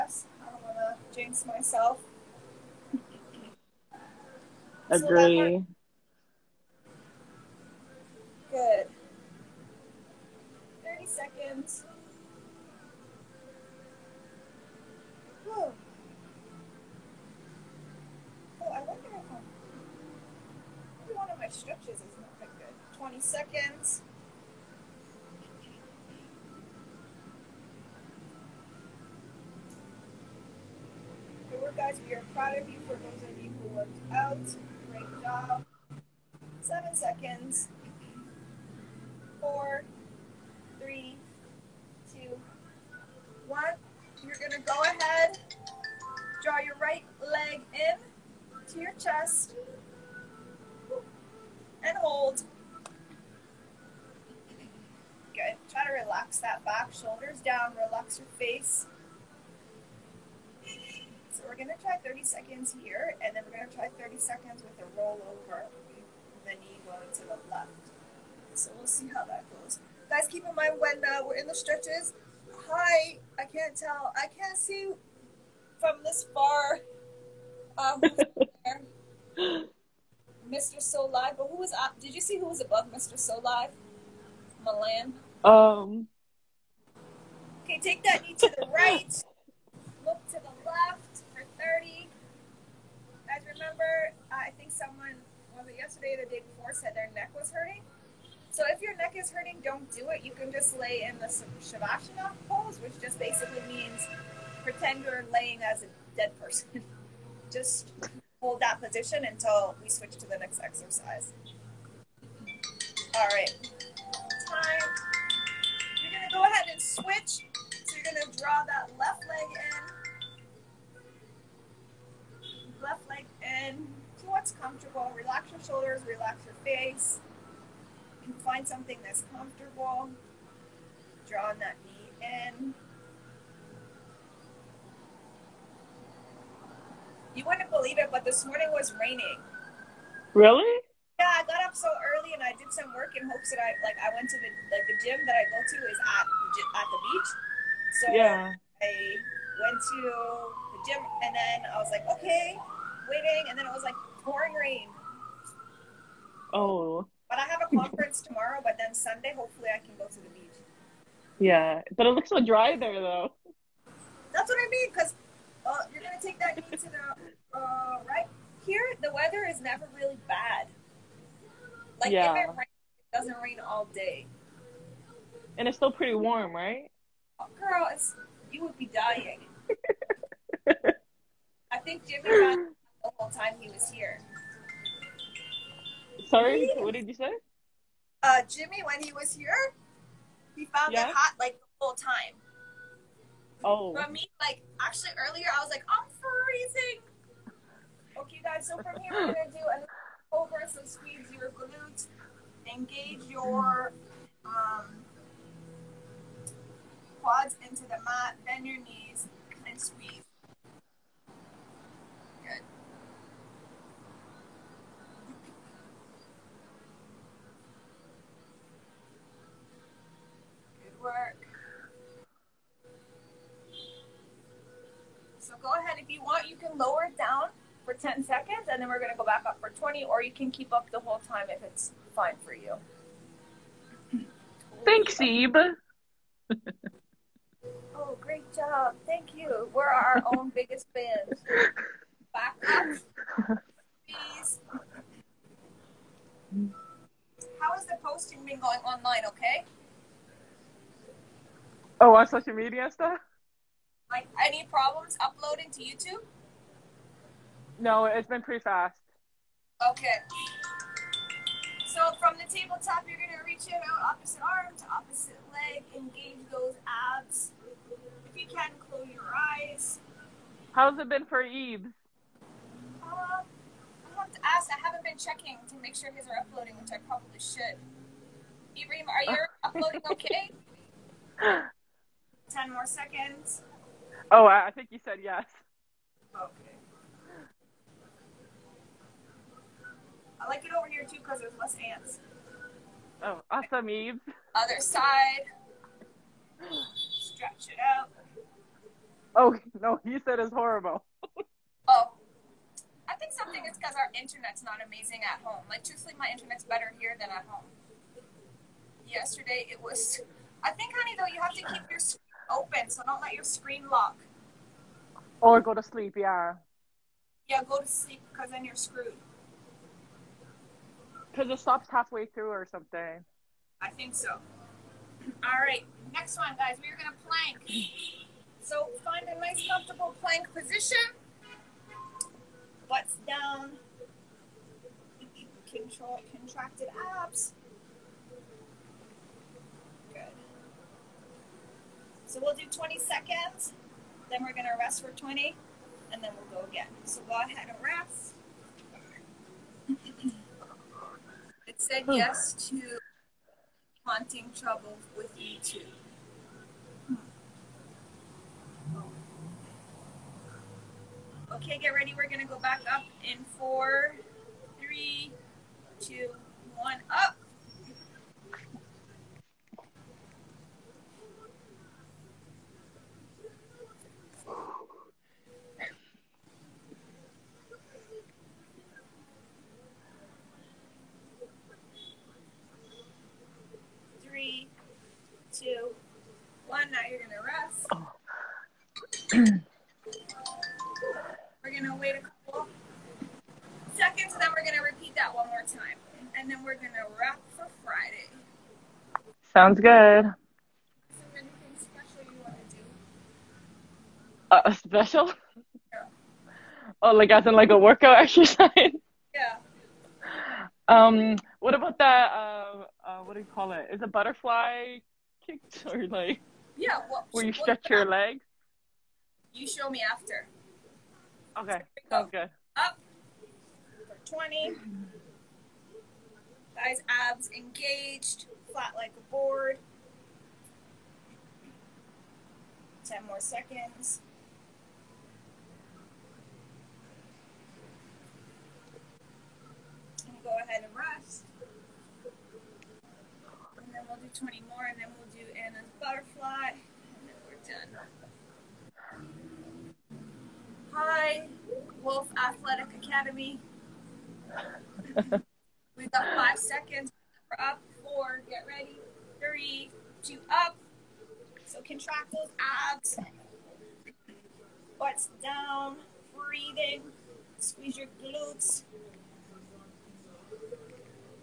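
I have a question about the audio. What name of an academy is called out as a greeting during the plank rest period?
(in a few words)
Wolf Athletic Academy.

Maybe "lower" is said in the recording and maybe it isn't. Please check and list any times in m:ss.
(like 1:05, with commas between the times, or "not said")
3:46.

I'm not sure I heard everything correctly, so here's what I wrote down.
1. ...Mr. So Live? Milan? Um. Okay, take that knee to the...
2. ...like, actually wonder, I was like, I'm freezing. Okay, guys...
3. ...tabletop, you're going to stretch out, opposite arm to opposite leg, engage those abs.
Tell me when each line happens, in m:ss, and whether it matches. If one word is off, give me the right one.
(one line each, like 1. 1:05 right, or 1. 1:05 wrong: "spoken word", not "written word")
1. 1:22 right
2. 3:14 wrong: "earlier", not "wonder"
3. 4:22 wrong: "reach", not "stretch".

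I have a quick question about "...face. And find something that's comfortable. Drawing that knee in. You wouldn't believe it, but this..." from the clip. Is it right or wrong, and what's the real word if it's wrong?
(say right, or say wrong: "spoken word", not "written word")
right.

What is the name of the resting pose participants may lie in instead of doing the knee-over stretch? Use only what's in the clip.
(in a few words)
Shavasana.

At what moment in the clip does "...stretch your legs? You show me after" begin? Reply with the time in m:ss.
6:57.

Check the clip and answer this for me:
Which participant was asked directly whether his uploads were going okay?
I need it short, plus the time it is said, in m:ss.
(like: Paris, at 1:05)
Ibrahim, at 4:38.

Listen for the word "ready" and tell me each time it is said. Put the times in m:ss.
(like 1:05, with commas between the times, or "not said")
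6:01, 7:38.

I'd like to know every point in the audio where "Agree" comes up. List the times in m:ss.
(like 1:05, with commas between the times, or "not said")
0:04.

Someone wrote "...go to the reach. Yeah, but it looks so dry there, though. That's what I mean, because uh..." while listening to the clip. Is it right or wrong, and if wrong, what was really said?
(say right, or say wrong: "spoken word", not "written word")
wrong: "beach", not "reach".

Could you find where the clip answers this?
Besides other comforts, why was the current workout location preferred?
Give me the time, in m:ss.
4:51.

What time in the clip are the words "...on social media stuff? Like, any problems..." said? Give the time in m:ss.
4:12.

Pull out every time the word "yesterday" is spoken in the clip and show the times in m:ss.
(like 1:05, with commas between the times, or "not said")
1:35, 5:09.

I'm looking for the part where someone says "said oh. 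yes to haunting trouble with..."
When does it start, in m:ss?
5:51.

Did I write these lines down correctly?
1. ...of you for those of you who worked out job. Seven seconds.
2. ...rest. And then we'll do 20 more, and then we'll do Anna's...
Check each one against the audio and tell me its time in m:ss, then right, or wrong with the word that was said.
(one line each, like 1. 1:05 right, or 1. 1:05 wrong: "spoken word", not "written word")
1. 0:32 right
2. 7:20 right.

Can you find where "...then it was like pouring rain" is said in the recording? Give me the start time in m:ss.
2:33.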